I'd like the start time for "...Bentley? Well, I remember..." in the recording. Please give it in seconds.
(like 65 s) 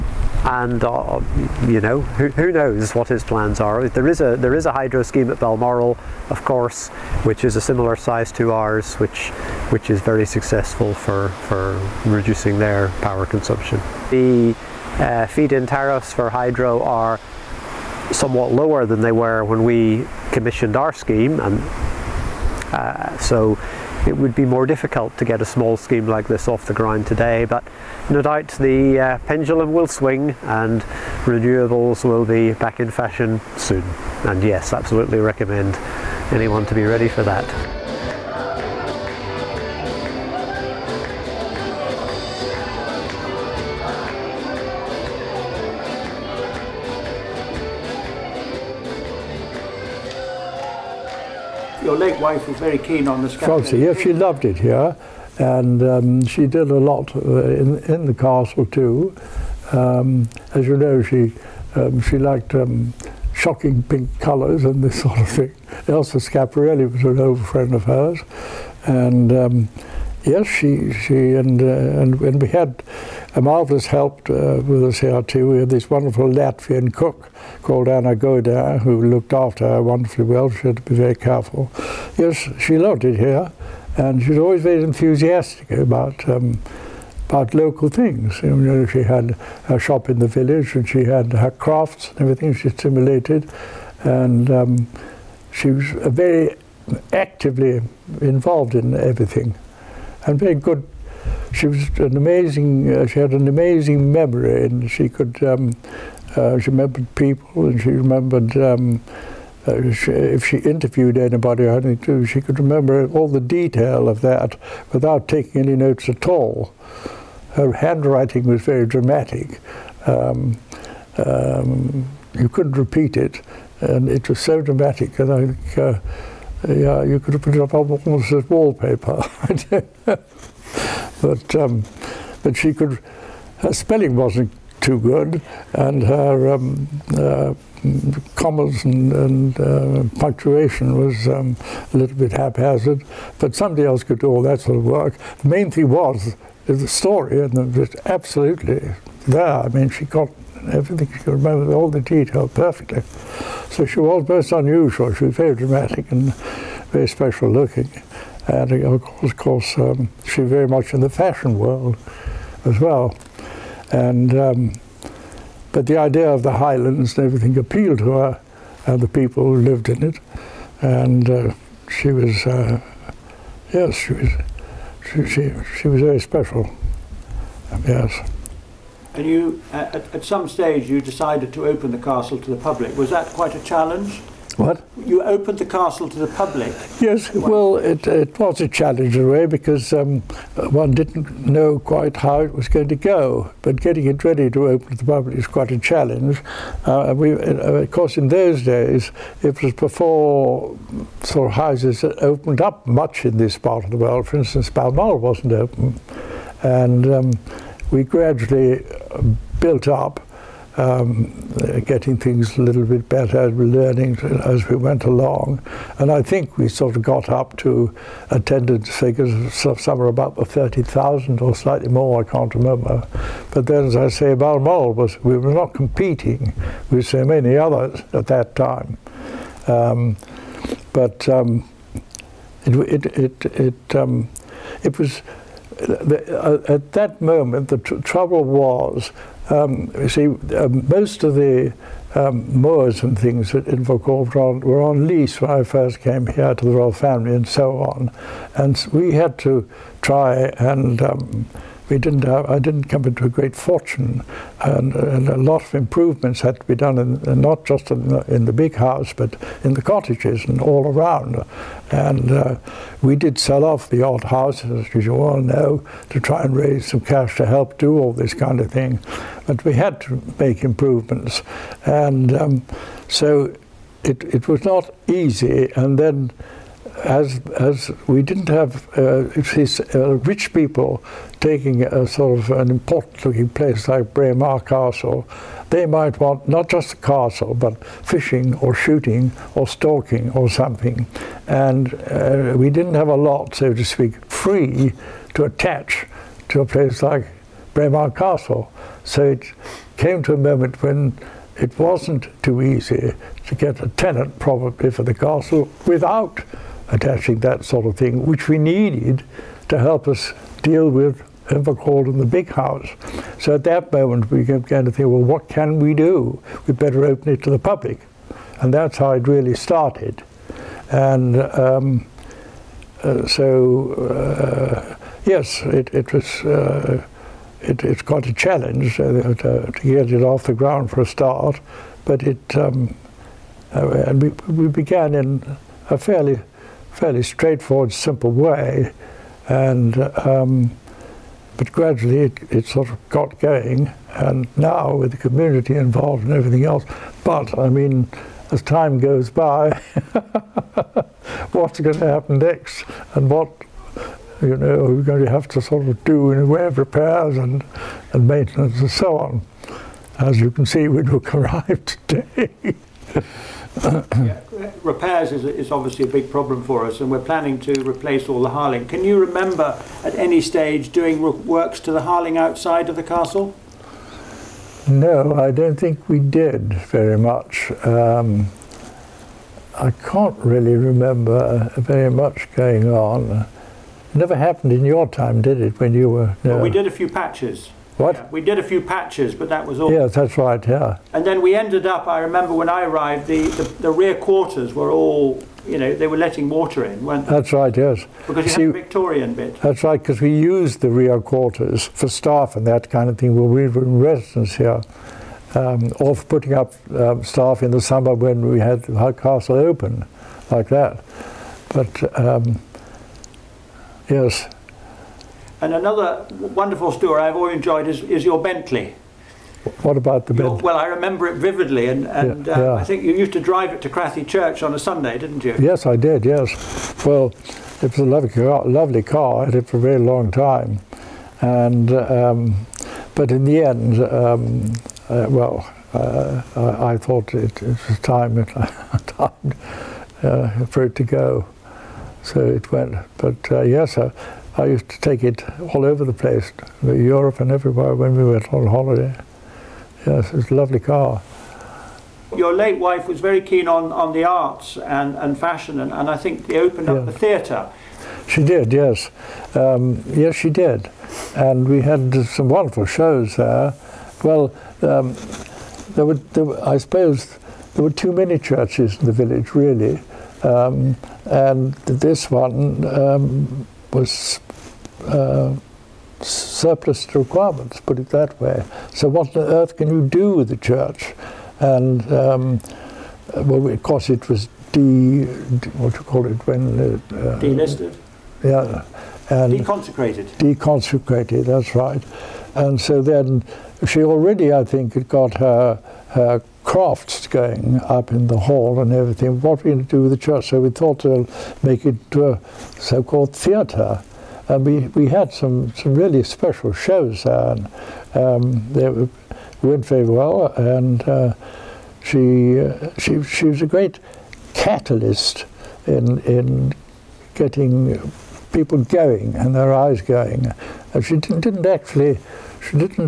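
420 s.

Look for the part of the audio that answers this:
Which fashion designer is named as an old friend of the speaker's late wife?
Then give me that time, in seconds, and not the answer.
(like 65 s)
65 s.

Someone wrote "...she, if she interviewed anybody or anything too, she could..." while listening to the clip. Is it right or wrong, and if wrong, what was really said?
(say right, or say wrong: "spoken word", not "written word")
right.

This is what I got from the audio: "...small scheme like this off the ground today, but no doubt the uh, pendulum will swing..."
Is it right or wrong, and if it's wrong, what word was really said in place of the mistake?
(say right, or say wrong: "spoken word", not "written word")
right.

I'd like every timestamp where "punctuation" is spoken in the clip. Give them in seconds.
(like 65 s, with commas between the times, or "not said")
140 s.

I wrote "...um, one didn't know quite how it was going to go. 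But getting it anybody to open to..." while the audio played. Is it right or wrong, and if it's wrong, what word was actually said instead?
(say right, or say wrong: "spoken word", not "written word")
wrong: "ready", not "anybody".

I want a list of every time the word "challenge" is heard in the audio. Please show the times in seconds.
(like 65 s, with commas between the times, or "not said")
183 s, 188 s, 195 s, 328 s.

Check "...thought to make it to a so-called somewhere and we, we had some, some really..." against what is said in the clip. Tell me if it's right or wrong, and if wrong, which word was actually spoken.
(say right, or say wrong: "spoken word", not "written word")
wrong: "theatre", not "somewhere".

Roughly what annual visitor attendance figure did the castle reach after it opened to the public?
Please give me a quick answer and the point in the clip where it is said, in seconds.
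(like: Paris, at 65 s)
30,000, at 220 s.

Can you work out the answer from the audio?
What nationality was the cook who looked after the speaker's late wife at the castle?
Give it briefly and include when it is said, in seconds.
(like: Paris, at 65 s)
Latvian, at 76 s.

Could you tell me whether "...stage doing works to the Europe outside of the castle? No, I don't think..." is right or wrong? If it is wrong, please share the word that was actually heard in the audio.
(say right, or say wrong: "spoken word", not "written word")
wrong: "Harling", not "Europe".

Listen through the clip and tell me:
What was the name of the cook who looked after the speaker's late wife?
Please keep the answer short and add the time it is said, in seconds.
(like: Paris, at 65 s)
Anna Goda, at 77 s.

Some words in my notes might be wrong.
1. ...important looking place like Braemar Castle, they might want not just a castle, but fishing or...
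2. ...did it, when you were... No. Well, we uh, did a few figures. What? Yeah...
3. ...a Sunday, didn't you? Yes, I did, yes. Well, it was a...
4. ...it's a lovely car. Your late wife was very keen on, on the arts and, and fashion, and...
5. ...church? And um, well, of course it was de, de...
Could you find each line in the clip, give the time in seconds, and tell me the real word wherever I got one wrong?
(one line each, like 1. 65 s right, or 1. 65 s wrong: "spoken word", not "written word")
1. 282 s right
2. 385 s wrong: "patches", not "figures"
3. 424 s right
4. 450 s right
5. 480 s right.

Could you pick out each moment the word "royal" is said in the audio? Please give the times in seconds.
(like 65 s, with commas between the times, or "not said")
246 s.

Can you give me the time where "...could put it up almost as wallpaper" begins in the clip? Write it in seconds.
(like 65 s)
127 s.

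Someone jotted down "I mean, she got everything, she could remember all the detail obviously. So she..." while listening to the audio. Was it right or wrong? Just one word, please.
wrong.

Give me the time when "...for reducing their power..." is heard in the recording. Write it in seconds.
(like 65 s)
11 s.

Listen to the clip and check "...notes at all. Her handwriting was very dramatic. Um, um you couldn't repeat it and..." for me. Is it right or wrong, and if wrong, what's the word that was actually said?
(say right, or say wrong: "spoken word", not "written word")
right.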